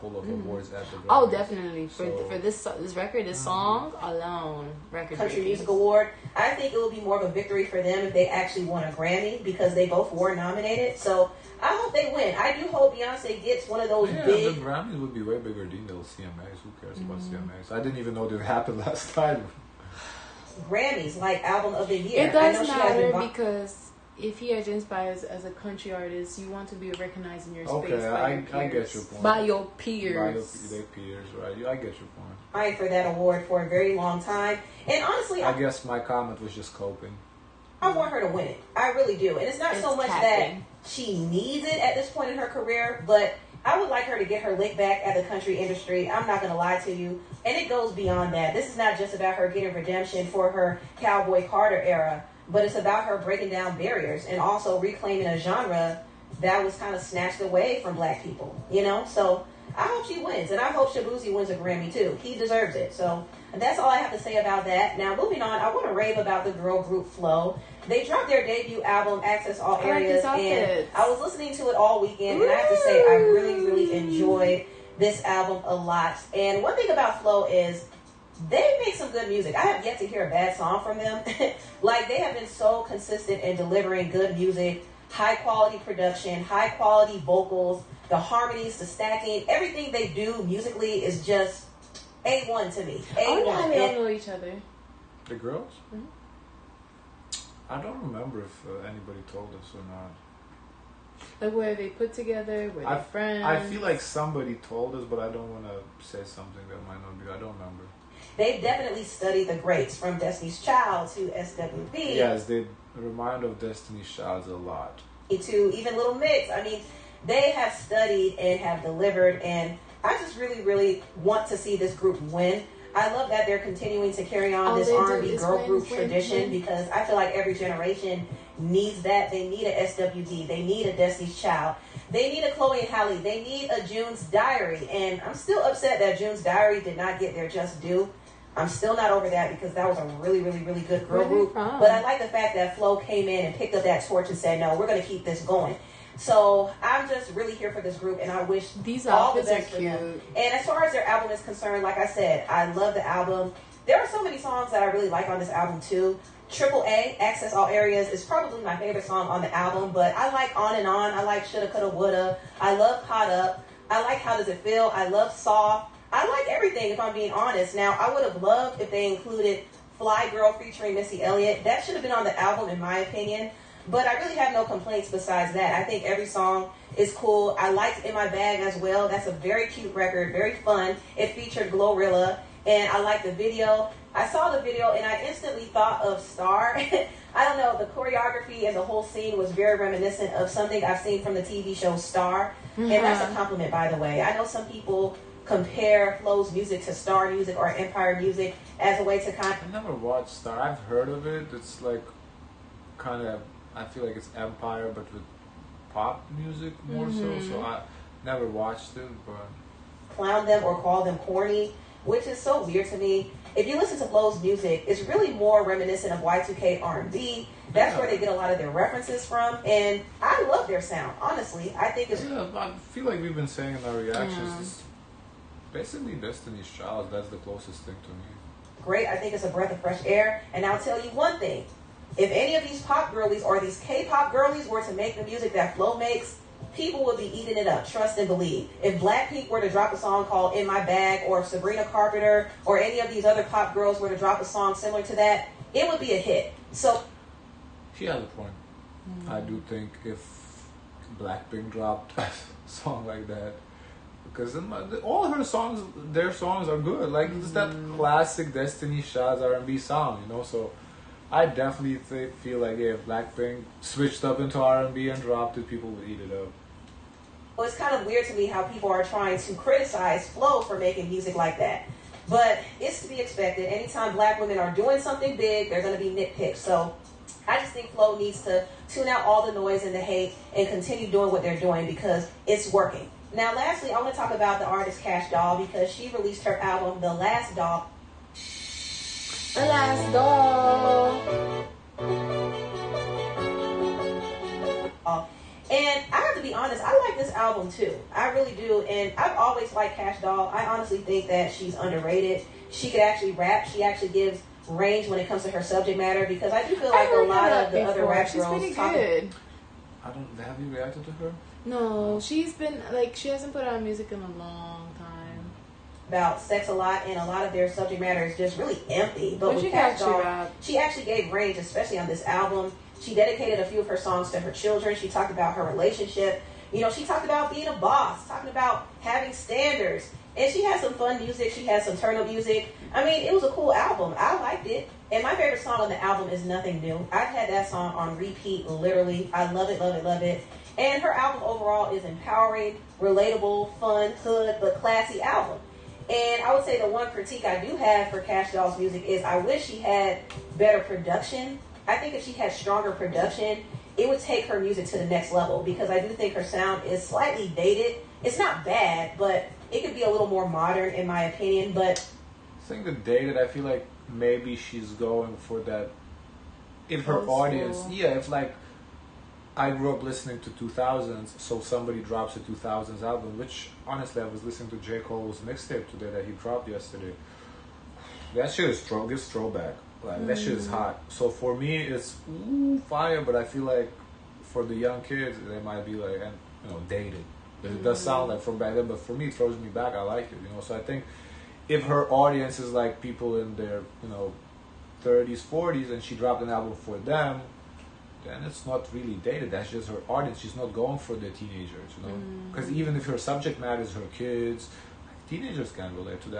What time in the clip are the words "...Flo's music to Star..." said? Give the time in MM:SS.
03:16.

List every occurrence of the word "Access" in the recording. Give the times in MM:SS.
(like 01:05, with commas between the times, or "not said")
01:09, 02:37.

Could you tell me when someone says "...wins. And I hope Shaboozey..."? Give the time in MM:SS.
01:00.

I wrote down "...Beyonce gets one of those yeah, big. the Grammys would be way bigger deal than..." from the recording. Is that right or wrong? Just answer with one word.
right.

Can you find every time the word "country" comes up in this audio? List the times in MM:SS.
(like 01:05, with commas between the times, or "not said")
00:05, 00:25, 00:45.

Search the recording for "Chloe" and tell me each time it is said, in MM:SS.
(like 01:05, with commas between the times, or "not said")
02:12.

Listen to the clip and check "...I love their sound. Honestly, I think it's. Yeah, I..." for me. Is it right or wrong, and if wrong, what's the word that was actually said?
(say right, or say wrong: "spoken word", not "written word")
right.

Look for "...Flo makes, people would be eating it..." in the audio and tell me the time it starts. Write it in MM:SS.
03:55.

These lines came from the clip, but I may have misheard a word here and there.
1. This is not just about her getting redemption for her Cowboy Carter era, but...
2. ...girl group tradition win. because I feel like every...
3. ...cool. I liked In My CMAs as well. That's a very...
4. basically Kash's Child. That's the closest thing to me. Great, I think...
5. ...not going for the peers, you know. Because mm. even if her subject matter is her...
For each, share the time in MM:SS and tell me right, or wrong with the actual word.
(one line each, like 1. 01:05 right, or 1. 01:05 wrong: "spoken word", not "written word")
1. 00:48 right
2. 02:05 right
3. 02:57 wrong: "Bag", not "CMAs"
4. 03:45 wrong: "Destiny", not "Kash"
5. 06:40 wrong: "teenagers", not "peers".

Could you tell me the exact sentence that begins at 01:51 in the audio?
Yes, they remind of Destiny's Child a lot.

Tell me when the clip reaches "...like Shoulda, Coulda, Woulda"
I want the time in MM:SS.
02:41.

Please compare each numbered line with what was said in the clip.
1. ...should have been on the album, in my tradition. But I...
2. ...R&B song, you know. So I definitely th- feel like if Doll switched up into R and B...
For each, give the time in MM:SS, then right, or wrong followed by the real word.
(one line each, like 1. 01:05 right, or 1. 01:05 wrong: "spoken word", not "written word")
1. 02:51 wrong: "opinion", not "tradition"
2. 04:19 wrong: "Blackpink", not "Doll".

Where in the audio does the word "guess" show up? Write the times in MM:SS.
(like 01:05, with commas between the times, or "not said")
00:35.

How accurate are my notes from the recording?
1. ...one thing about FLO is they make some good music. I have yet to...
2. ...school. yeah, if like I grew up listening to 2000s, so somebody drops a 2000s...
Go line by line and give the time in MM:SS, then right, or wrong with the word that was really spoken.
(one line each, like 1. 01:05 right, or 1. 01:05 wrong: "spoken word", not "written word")
1. 01:16 right
2. 06:07 right.